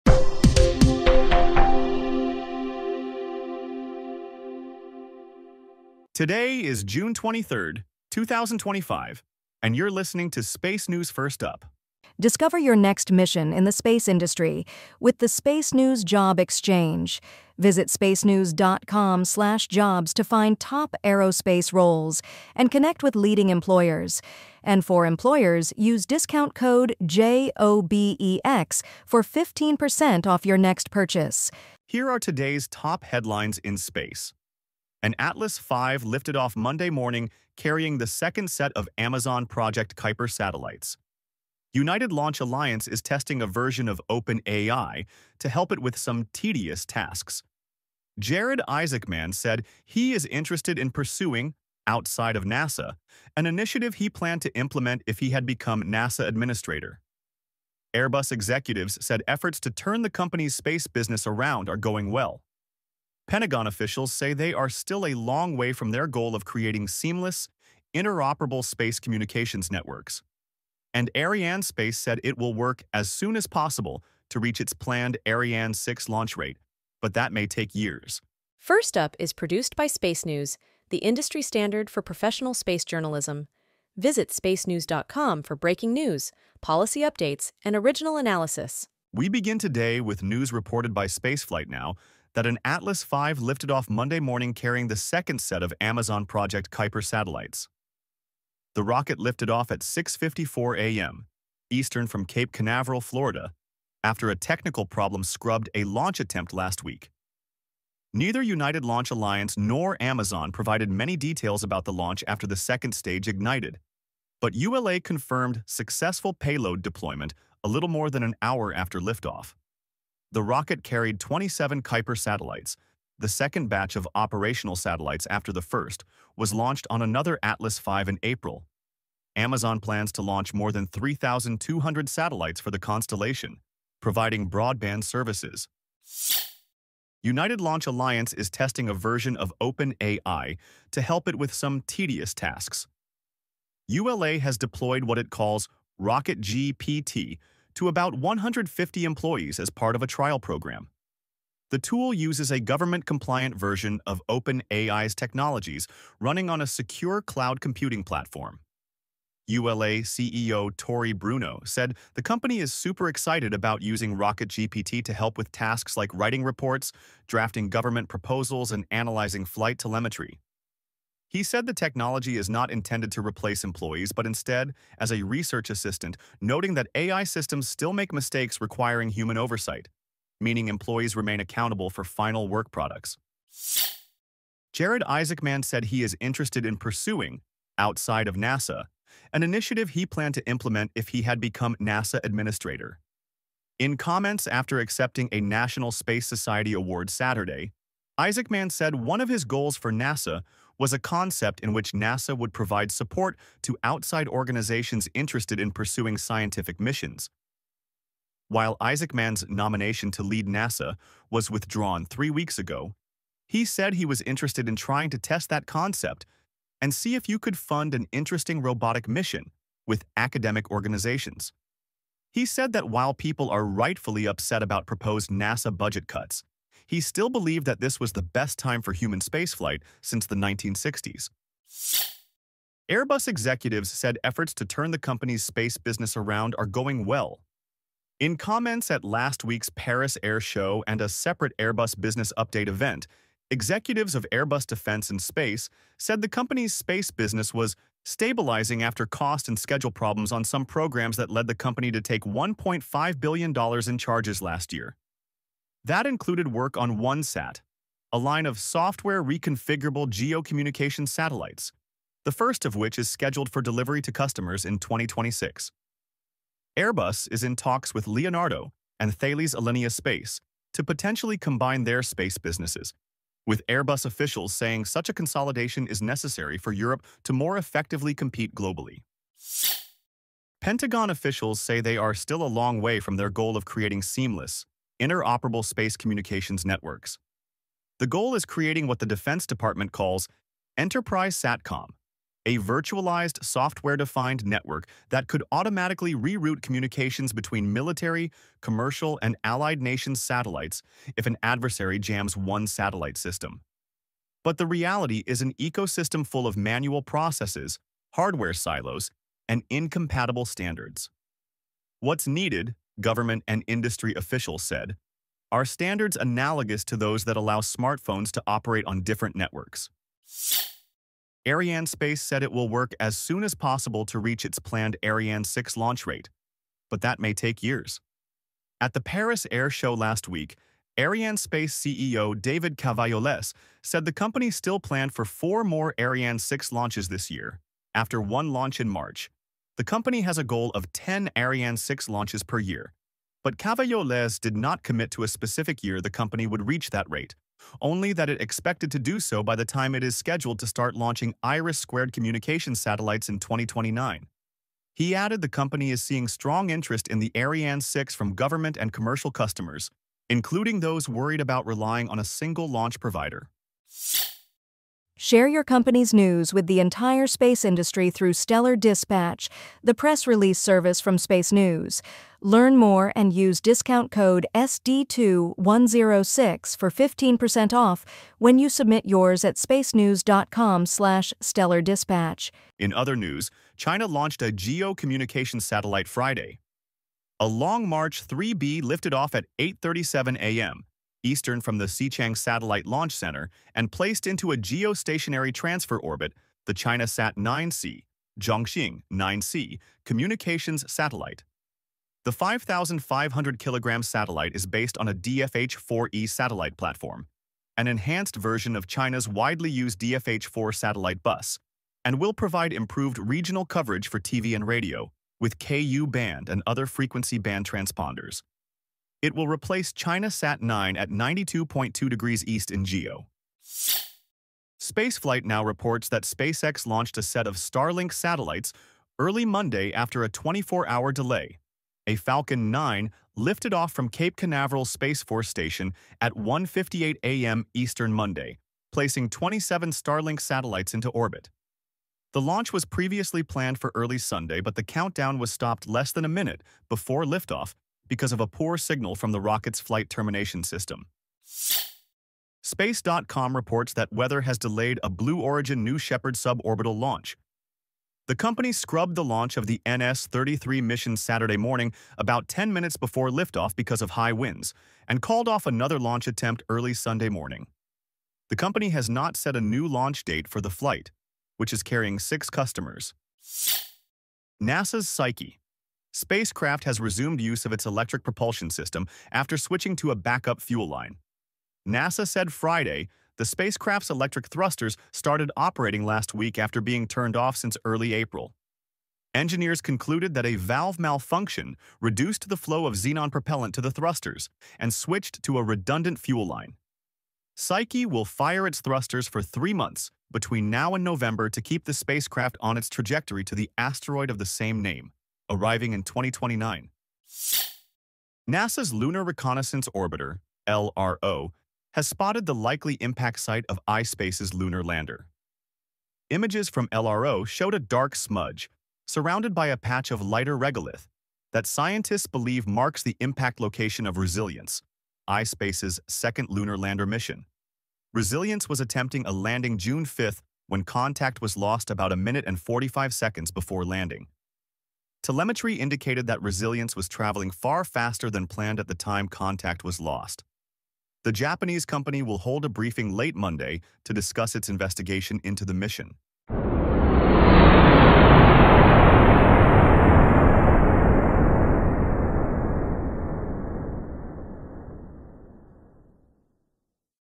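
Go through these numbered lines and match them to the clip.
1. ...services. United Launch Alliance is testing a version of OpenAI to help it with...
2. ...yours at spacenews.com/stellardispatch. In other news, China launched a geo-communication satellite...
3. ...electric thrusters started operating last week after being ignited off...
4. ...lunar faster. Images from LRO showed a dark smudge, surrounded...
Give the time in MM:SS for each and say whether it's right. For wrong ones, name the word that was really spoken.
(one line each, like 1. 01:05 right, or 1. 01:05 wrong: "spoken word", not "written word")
1. 02:15 right
2. 06:19 right
3. 08:04 wrong: "turned", not "ignited"
4. 08:34 wrong: "lander", not "faster".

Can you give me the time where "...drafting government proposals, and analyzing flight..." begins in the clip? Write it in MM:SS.
02:47.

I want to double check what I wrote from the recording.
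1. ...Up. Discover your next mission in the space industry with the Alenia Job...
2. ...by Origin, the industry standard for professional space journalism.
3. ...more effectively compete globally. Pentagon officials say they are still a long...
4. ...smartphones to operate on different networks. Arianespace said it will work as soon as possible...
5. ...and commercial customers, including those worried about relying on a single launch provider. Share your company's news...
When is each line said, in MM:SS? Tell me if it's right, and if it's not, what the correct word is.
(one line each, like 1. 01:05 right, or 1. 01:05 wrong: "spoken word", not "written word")
1. 00:11 wrong: "SpaceNews", not "Alenia"
2. 01:19 wrong: "SpaceNews", not "Origin"
3. 04:37 right
4. 05:17 right
5. 05:58 right.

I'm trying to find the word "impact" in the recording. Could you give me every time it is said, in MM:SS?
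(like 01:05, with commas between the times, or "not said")
08:32, 08:43.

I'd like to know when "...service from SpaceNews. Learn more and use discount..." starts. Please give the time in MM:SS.
06:10.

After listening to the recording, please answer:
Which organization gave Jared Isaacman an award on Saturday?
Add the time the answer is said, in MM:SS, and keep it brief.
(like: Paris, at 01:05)
National Space Society, at 03:15.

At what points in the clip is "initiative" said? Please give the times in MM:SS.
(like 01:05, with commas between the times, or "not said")
00:53, 03:09.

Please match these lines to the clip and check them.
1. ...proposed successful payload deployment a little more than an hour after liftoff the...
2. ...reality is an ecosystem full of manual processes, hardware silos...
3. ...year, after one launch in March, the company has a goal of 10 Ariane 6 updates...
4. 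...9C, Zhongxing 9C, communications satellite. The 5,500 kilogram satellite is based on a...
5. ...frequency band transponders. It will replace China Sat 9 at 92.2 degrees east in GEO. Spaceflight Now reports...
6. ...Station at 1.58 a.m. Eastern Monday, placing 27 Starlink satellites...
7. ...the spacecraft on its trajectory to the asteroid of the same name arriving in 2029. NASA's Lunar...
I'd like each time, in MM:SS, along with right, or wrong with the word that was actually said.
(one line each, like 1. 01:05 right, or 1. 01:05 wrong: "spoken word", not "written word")
1. 01:54 wrong: "confirmed", not "proposed"
2. 05:04 right
3. 05:37 wrong: "launches", not "updates"
4. 06:37 right
5. 06:56 right
6. 07:15 right
7. 08:21 right.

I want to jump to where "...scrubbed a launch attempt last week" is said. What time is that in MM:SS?
01:45.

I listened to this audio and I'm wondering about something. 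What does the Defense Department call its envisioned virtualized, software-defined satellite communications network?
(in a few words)
Enterprise SATCOM.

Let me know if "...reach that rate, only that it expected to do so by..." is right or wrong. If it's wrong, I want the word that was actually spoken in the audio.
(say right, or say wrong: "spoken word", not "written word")
right.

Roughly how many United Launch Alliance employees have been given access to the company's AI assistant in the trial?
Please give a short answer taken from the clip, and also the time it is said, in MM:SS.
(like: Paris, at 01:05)
150, at 02:28.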